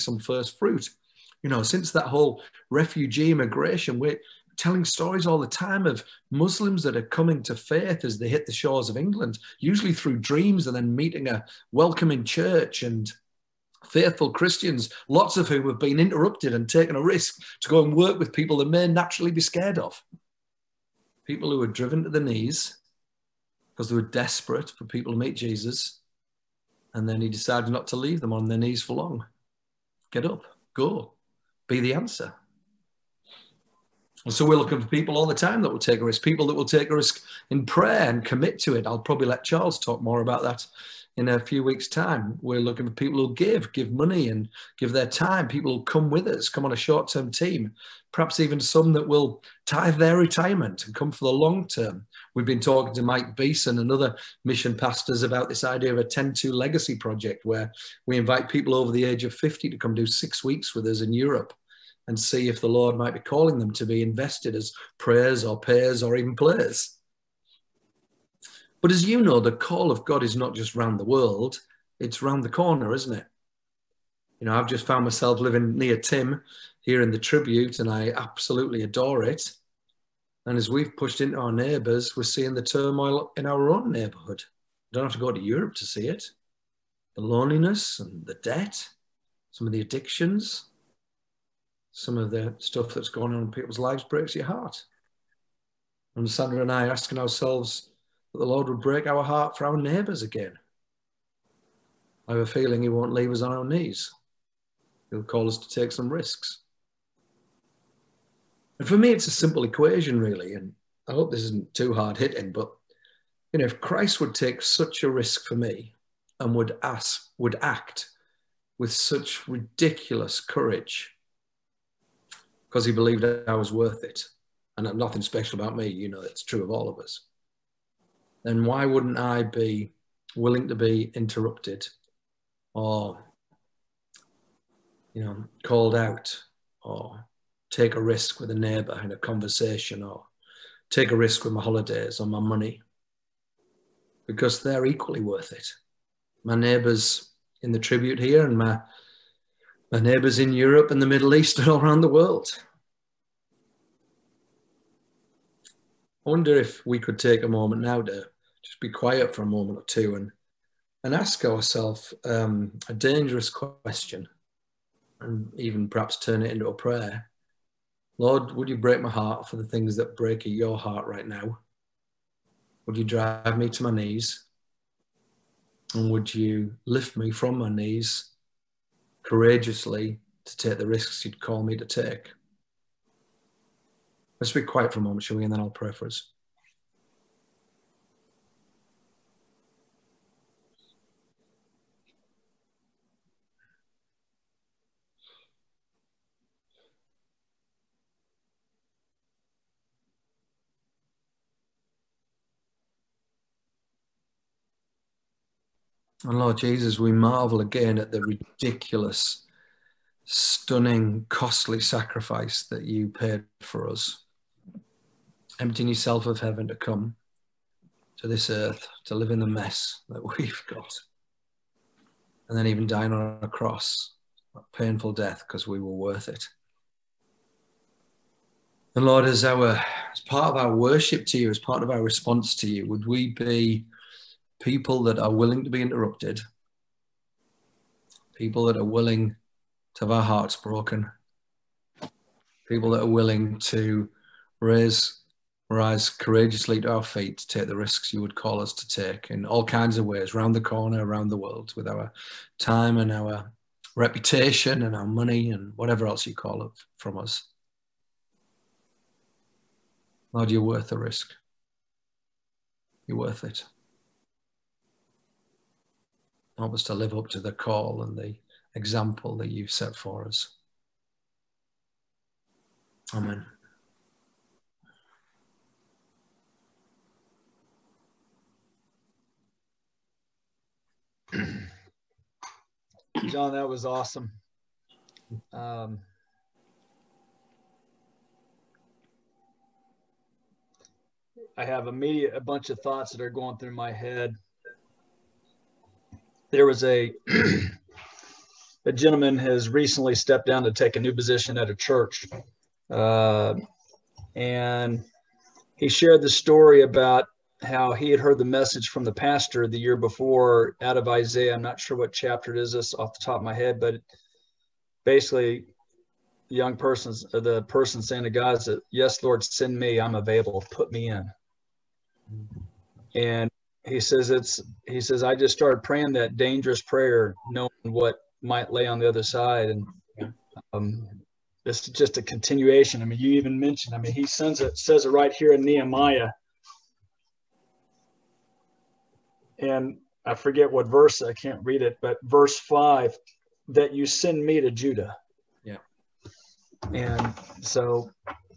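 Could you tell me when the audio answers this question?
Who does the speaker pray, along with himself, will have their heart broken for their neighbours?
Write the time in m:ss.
1:36.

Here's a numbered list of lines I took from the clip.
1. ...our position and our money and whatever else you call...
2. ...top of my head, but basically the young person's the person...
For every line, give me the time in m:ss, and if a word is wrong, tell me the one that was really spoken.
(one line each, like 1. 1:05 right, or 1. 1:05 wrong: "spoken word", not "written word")
1. 4:13 wrong: "reputation", not "position"
2. 5:13 right.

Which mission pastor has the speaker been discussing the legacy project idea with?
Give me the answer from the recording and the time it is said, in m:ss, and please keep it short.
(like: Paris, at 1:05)
Mike Beeson, at 0:53.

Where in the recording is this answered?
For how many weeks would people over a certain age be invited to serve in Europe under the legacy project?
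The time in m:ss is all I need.
1:00.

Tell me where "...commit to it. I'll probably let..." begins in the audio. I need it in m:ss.
0:38.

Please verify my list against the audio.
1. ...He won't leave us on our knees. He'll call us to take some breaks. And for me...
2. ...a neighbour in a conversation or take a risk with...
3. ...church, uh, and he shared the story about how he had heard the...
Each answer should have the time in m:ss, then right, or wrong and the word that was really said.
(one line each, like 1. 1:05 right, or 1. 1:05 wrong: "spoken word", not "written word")
1. 1:42 wrong: "risks", not "breaks"
2. 2:18 right
3. 5:01 right.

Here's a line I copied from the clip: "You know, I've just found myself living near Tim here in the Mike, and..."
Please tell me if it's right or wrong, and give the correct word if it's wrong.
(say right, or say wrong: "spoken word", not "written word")
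wrong: "Tribute", not "Mike".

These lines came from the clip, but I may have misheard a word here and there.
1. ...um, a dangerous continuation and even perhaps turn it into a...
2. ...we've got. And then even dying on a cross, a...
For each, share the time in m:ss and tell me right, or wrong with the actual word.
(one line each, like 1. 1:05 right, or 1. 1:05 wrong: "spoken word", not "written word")
1. 2:42 wrong: "question", not "continuation"
2. 3:40 right.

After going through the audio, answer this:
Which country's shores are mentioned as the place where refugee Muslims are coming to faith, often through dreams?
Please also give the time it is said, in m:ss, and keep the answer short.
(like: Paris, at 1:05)
England, at 0:08.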